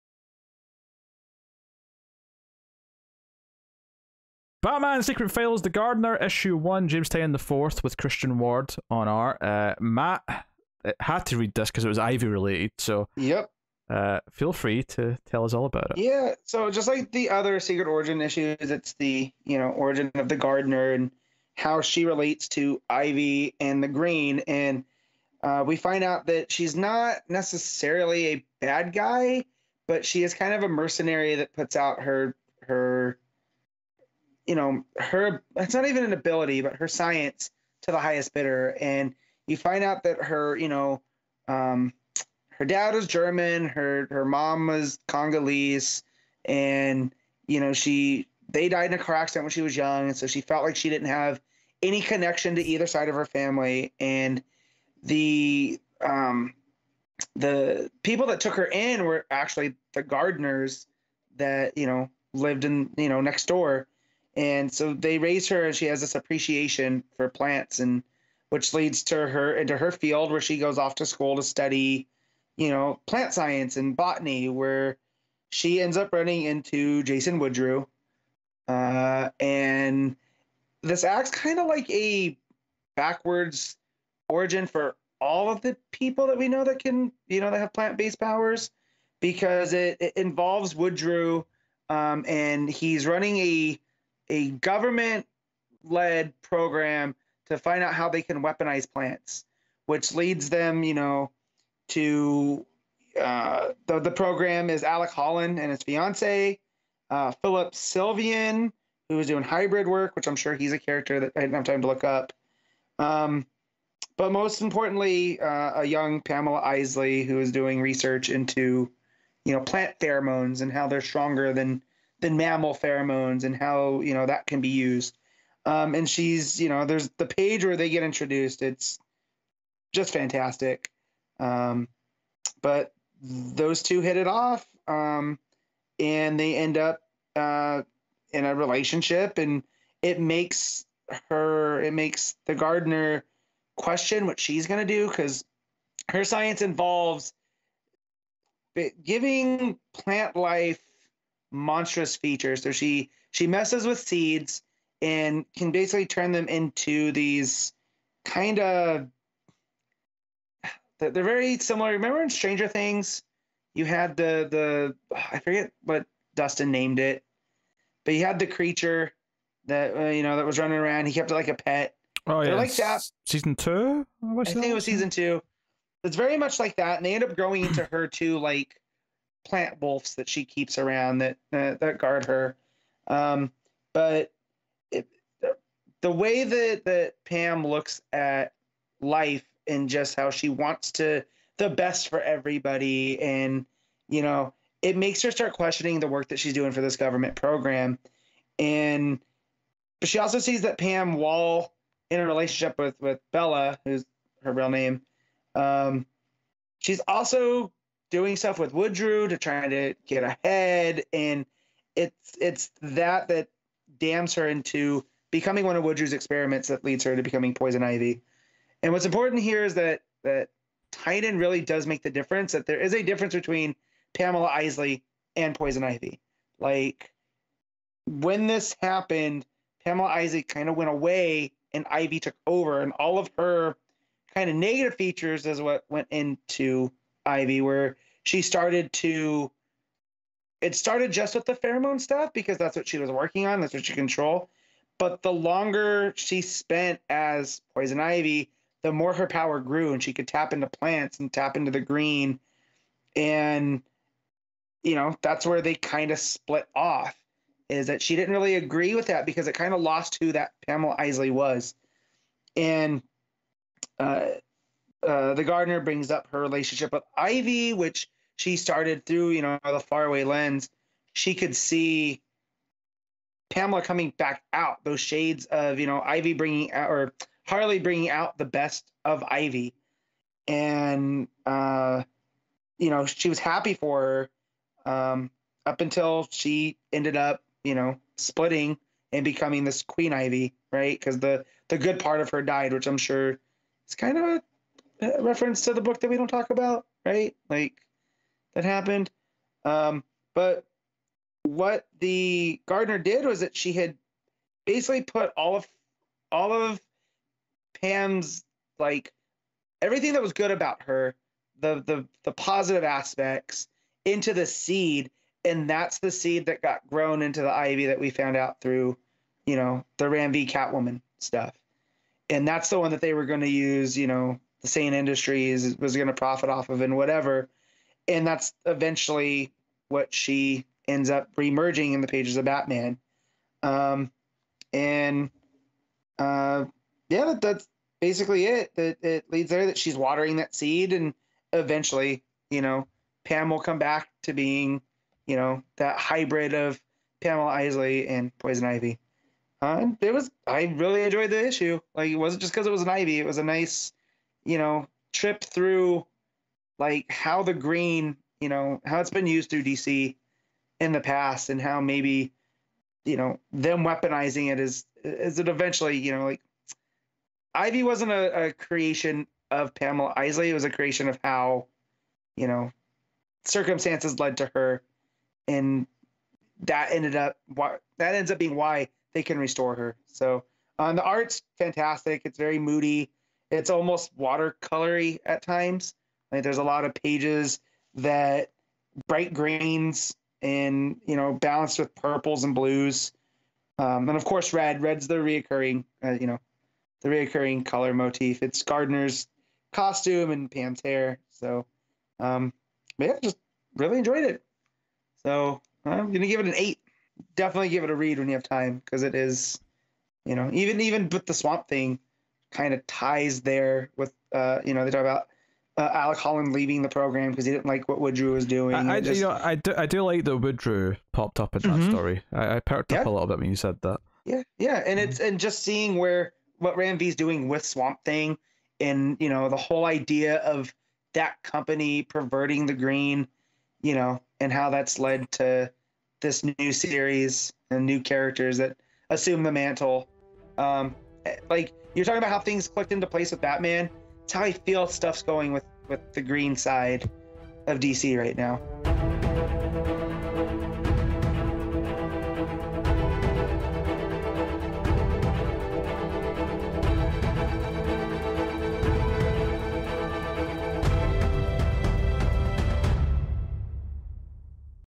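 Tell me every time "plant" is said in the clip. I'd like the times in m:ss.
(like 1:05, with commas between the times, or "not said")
1:07, 1:13, 1:27, 1:38, 1:59, 2:29, 2:59, 4:10.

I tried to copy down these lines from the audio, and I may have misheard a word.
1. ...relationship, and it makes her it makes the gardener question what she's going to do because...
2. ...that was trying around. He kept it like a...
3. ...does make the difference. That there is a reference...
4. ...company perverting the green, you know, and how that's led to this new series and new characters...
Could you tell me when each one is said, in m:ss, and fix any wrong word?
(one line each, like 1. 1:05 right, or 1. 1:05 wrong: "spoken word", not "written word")
1. 2:18 right
2. 2:50 wrong: "running", not "trying"
3. 3:41 wrong: "difference", not "reference"
4. 7:11 right.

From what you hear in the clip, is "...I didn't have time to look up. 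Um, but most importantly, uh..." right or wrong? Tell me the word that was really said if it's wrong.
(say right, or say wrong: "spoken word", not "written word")
right.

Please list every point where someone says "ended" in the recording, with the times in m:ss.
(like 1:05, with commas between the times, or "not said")
4:46, 6:16.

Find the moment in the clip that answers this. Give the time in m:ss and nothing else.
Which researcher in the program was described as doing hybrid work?
1:47.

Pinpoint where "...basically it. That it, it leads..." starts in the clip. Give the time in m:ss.
5:37.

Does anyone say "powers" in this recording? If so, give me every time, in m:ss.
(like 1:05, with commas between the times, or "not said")
1:28, 4:09.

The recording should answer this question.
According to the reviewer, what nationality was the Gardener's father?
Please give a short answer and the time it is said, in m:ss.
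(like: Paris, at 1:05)
German, at 0:43.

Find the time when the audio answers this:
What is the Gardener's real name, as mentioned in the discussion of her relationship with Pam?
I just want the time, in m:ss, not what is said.
3:23.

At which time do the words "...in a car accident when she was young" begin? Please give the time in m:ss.
0:48.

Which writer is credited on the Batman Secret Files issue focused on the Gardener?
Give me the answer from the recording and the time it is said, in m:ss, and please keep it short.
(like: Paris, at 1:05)
James Tynion IV, at 0:06.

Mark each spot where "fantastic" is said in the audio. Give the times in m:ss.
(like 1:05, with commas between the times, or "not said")
2:10, 6:21.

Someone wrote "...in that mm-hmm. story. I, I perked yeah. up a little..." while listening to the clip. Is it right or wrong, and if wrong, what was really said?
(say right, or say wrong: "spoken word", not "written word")
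right.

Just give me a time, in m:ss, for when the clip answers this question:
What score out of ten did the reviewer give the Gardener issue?
6:46.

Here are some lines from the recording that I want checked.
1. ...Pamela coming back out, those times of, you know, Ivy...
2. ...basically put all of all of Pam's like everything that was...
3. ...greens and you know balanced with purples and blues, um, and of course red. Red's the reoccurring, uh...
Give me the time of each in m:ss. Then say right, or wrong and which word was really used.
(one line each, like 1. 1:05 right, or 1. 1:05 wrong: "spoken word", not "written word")
1. 4:33 wrong: "shades", not "times"
2. 5:04 right
3. 6:29 right.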